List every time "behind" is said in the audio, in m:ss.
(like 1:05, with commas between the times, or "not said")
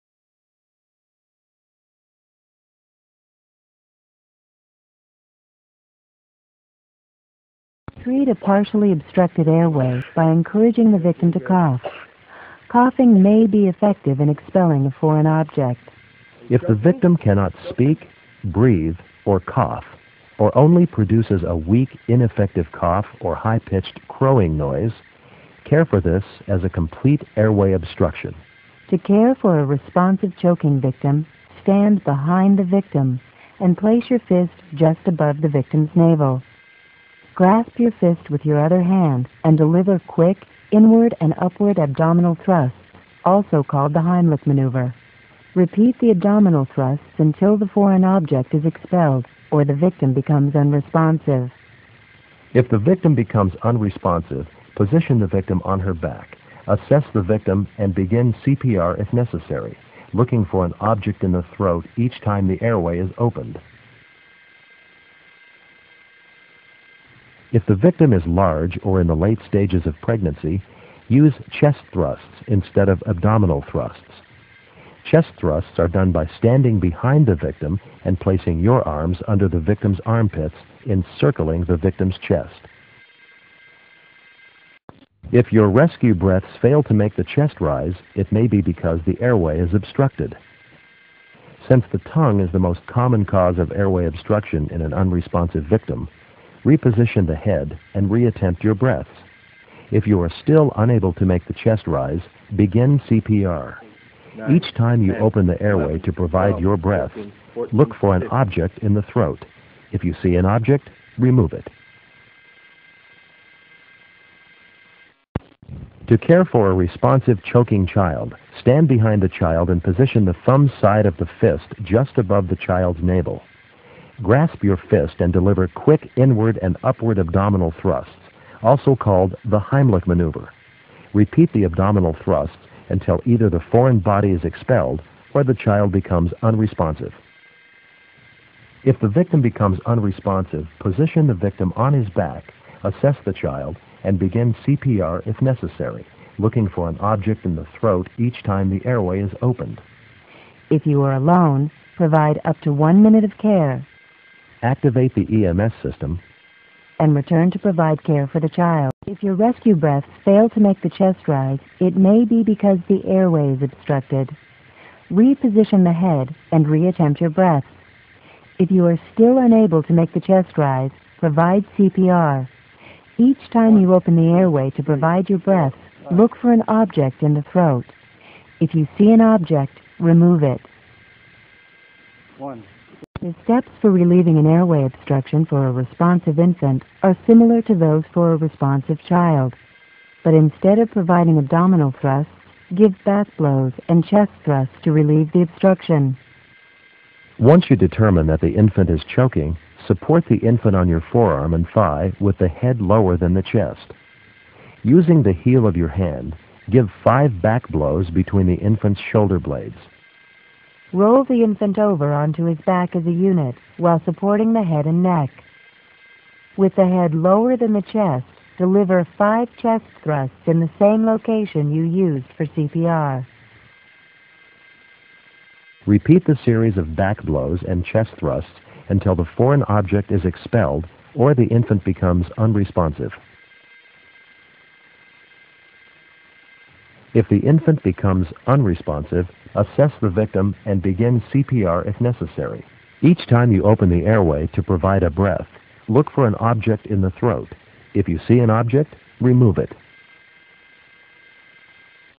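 0:32, 1:16, 1:58.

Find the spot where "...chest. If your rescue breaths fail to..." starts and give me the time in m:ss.
1:22.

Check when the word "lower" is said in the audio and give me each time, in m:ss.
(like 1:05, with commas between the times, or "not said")
3:22, 3:37.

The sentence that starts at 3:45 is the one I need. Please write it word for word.
Repeat the series of back blows and chest thrusts until the foreign object is expelled or the infant becomes unresponsive.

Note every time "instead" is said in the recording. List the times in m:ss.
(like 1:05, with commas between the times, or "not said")
1:12, 3:10.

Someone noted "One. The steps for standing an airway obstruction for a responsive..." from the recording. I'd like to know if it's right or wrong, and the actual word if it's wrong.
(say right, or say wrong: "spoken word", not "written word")
wrong: "relieving", not "standing".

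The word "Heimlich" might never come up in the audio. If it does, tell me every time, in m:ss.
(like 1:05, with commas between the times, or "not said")
0:44, 2:09.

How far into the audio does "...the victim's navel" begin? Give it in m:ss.
0:35.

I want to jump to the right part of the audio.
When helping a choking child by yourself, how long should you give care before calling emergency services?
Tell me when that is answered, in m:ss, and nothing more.
2:32.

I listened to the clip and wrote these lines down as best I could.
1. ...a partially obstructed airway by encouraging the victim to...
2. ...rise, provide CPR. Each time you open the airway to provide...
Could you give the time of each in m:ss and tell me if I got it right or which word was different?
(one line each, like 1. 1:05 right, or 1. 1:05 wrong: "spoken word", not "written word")
1. 0:08 right
2. 2:50 right.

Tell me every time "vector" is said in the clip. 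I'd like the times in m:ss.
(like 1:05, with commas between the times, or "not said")
not said.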